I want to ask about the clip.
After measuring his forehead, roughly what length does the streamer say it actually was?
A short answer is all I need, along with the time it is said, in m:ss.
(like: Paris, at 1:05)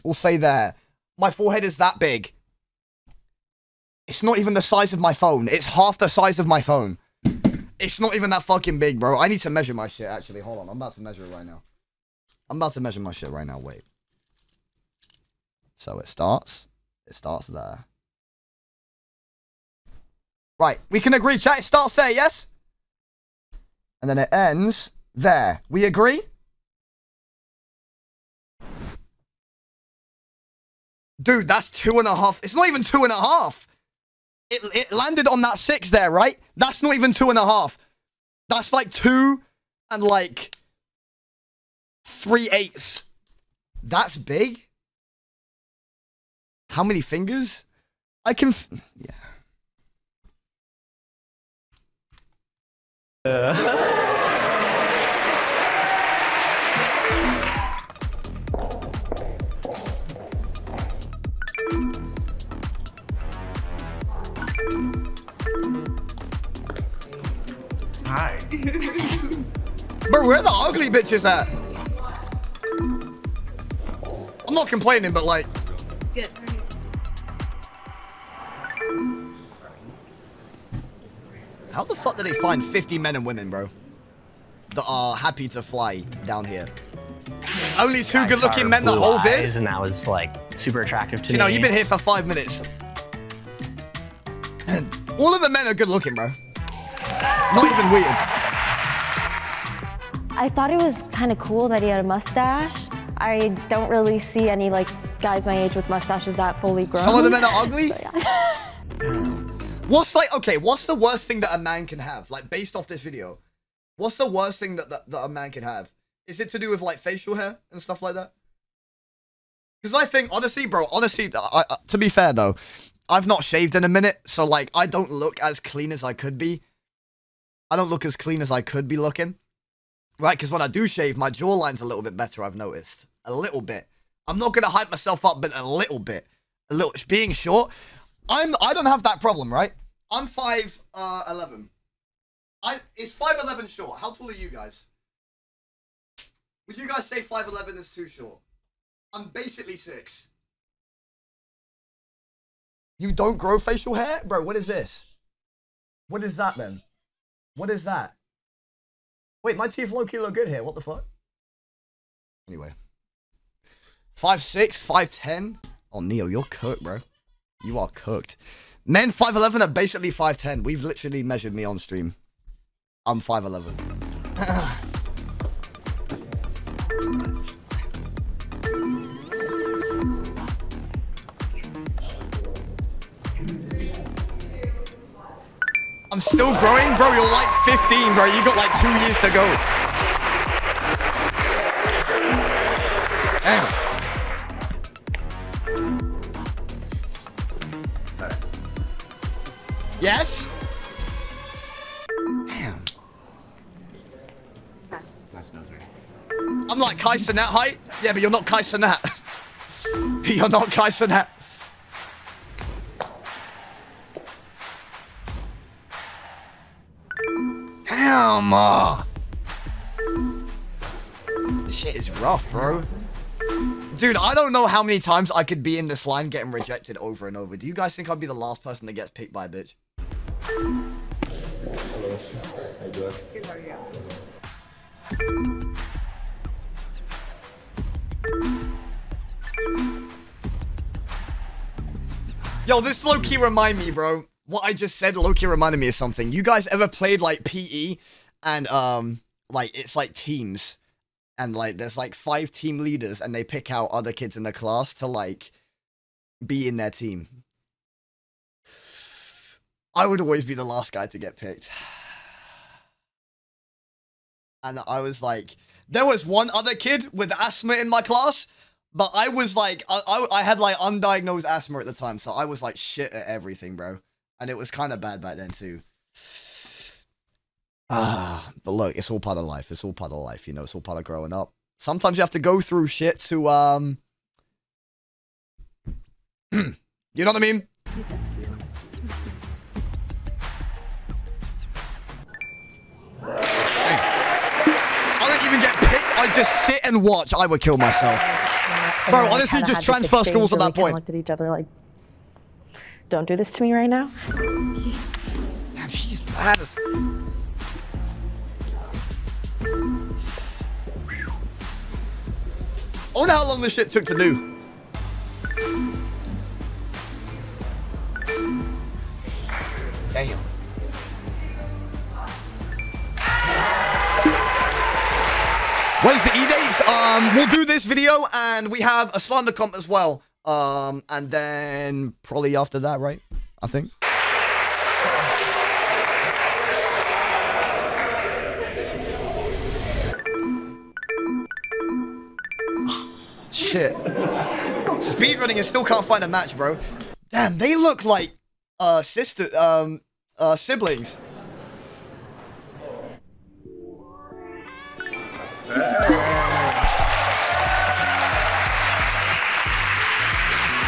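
2 and 3/8, at 0:38.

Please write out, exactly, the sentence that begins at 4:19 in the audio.
I would always be the last guy to get picked.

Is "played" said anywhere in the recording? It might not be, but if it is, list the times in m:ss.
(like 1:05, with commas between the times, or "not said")
4:06.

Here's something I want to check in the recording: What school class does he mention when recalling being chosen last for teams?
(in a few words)
PE.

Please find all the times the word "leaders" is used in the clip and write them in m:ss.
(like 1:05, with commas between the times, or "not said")
4:12.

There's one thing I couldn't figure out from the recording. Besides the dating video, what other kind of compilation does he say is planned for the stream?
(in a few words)
slander comp.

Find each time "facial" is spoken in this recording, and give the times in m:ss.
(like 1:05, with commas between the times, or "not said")
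1:56, 2:33.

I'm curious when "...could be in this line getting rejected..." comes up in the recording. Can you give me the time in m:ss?
3:45.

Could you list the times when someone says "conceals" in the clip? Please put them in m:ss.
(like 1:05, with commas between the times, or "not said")
not said.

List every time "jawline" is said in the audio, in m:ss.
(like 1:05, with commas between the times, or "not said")
2:11.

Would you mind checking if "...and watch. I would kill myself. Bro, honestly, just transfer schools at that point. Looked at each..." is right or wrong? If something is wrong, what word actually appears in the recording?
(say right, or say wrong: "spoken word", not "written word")
right.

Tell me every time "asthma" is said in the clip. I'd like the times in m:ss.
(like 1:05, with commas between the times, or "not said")
4:27, 4:31.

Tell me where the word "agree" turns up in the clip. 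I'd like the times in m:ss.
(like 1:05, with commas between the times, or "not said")
0:21, 0:25.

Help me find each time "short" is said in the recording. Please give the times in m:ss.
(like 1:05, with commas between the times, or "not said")
2:17, 2:23, 2:28.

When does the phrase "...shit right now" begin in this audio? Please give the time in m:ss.
0:13.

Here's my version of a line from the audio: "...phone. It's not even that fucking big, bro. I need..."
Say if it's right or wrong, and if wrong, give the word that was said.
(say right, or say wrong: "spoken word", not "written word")
right.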